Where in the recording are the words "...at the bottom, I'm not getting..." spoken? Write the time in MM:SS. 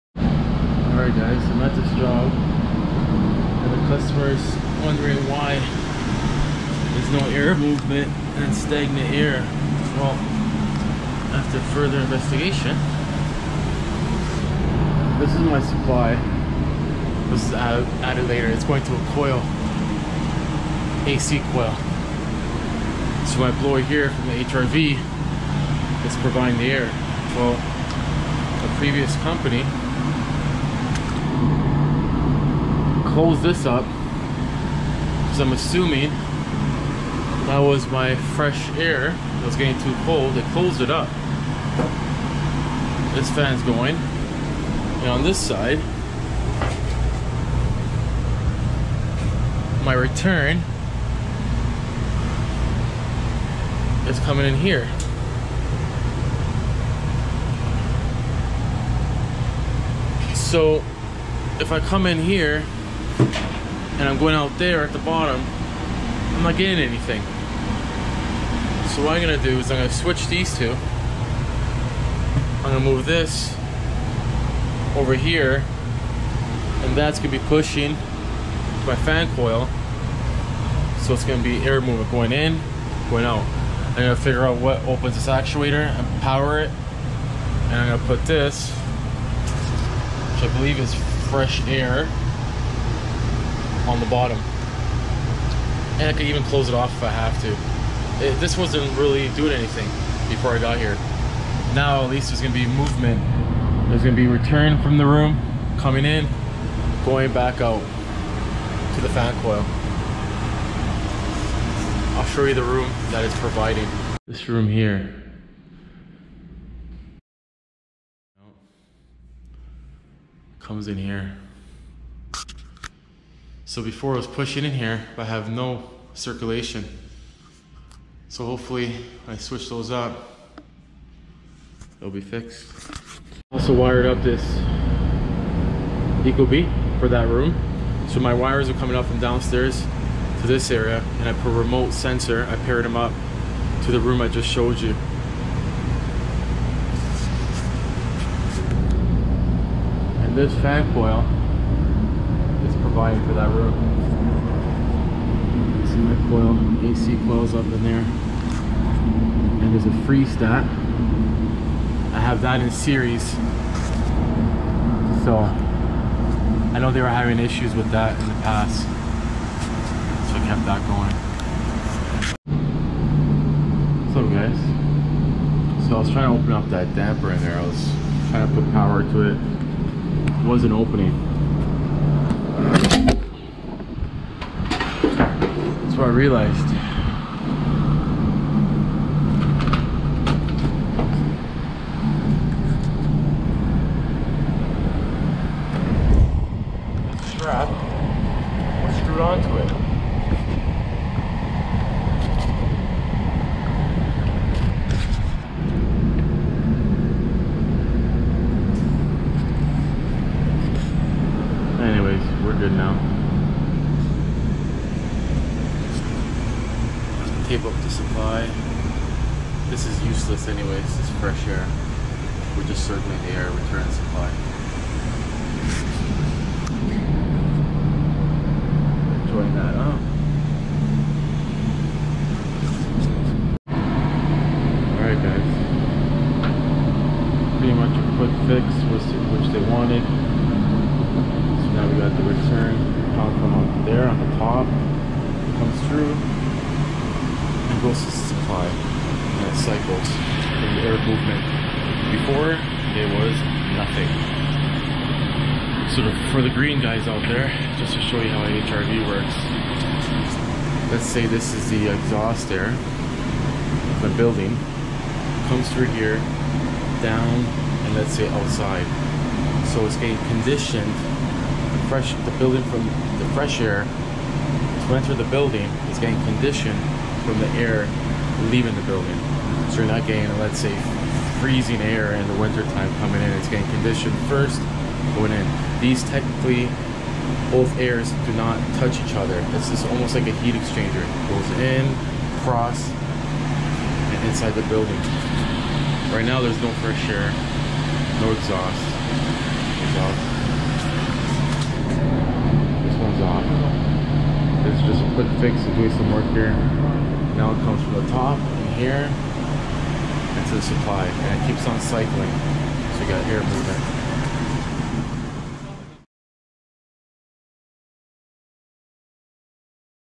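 01:04.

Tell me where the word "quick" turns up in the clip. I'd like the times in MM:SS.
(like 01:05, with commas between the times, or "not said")
03:58, 05:05.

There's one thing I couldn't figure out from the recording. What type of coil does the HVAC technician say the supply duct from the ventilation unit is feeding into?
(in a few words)
AC coil.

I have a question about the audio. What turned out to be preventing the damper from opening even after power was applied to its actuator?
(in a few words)
strap screwed onto it.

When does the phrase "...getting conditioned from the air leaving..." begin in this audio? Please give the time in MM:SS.
04:35.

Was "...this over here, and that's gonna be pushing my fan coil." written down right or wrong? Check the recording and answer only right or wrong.
right.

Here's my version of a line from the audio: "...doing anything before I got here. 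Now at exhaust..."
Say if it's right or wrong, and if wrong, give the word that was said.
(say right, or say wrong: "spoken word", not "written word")
wrong: "least", not "exhaust".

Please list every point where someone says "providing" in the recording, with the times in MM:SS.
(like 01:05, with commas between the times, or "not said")
00:26, 01:53.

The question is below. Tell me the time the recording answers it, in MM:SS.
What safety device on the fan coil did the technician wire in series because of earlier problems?
02:40.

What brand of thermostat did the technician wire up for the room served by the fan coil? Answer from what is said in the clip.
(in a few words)
Ecobee.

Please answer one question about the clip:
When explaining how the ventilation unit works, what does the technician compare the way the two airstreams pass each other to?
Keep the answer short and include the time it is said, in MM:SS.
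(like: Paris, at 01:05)
heat exchanger, at 04:50.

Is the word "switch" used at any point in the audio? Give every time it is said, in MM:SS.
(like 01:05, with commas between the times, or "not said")
01:09, 02:09.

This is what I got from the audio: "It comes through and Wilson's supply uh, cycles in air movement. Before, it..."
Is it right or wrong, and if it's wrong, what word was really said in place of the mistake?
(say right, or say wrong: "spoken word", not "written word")
right.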